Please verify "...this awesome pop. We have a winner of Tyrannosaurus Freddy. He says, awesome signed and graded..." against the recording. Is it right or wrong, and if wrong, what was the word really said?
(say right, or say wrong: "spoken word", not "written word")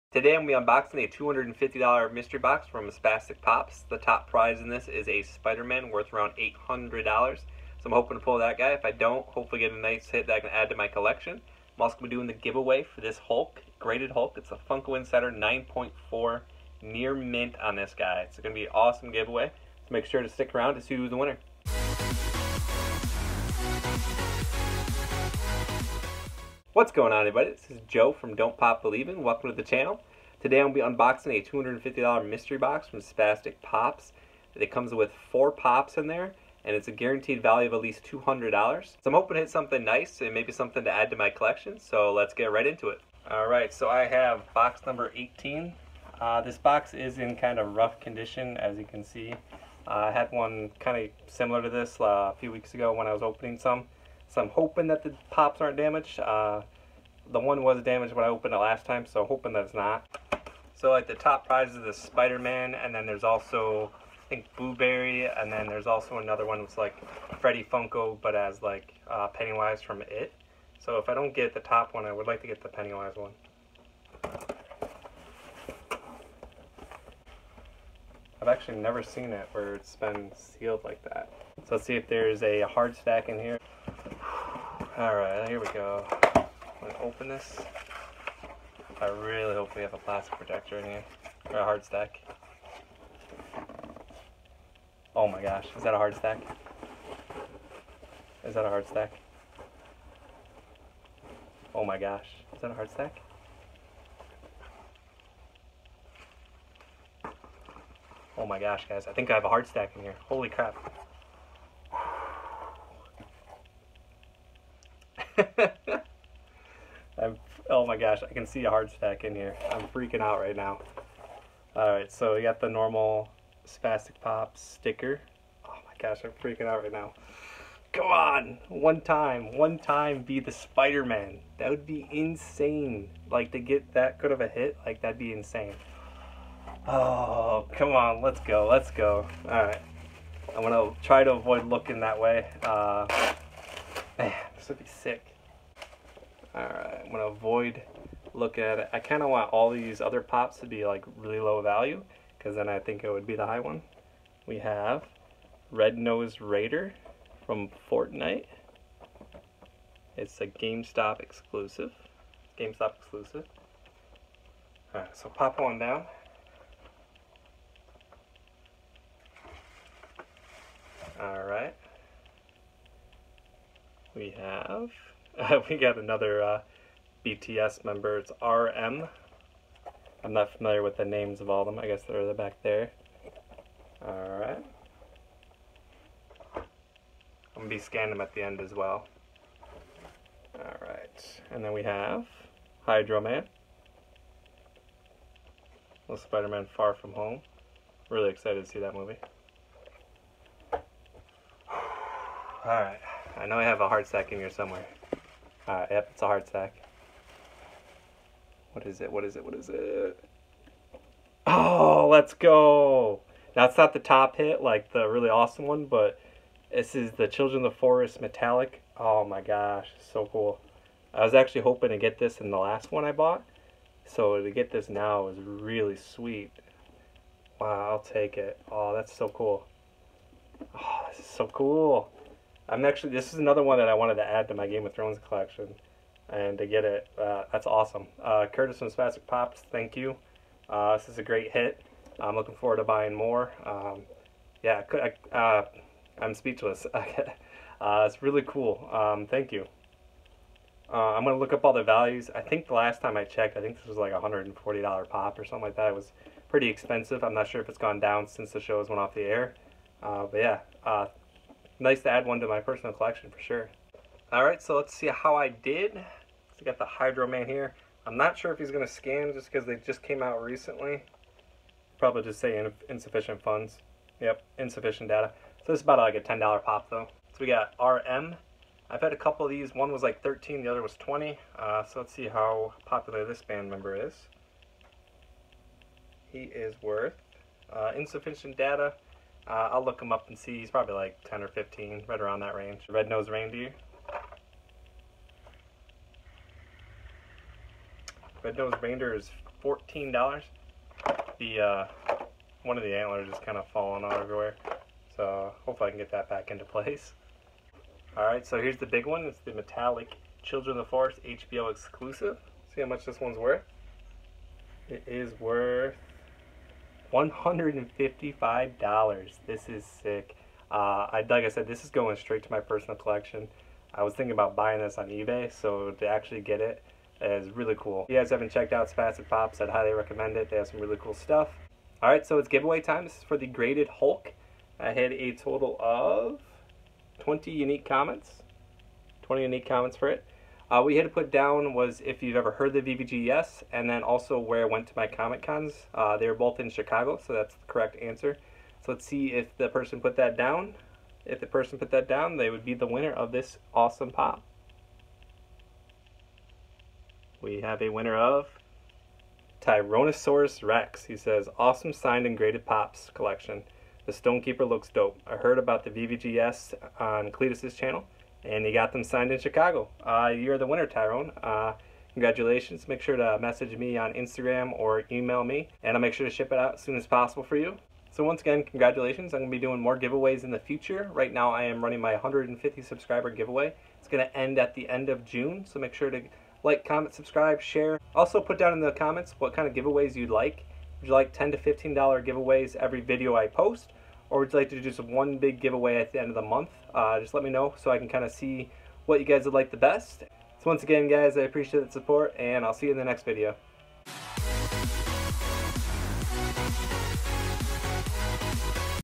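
wrong: "Rex", not "Freddy".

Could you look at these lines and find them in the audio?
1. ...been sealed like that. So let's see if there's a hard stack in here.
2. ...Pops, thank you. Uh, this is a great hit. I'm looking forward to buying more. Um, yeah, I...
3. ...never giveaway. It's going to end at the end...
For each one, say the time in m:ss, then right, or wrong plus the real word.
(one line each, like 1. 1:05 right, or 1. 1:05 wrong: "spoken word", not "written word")
1. 1:19 right
2. 3:59 right
3. 6:22 wrong: "subscriber", not "never".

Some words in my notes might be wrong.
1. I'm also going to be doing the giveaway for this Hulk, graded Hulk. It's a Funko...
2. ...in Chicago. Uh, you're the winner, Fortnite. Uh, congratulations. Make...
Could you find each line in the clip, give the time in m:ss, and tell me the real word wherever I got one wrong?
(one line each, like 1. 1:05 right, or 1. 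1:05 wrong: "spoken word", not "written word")
1. 0:11 right
2. 6:09 wrong: "Tyrone", not "Fortnite".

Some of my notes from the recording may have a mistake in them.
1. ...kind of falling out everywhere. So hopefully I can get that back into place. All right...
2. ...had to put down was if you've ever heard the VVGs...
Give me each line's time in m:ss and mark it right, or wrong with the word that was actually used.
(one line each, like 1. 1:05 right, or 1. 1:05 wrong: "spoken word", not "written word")
1. 5:03 right
2. 5:41 right.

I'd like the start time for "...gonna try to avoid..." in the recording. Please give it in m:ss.
2:20.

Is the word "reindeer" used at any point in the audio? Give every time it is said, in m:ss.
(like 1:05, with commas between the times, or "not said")
4:53, 4:58.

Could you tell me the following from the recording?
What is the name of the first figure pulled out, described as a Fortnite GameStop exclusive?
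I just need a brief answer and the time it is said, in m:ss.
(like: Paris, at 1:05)
Red Nose Raider, at 2:35.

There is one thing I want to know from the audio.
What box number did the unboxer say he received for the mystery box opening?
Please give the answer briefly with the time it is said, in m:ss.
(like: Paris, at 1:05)
18, at 0:44.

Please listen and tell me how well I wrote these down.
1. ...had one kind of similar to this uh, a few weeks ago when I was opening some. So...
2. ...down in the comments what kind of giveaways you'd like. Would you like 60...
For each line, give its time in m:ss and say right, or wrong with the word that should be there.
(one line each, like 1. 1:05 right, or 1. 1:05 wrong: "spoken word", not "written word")
1. 0:50 right
2. 6:28 wrong: "10", not "60".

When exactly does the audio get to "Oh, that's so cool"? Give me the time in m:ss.
3:48.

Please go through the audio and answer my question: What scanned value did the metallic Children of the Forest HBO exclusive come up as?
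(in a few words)
$155.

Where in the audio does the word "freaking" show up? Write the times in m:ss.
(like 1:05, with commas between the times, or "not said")
1:59, 2:06.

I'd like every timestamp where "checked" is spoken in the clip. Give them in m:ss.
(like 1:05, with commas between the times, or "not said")
4:13, 5:28.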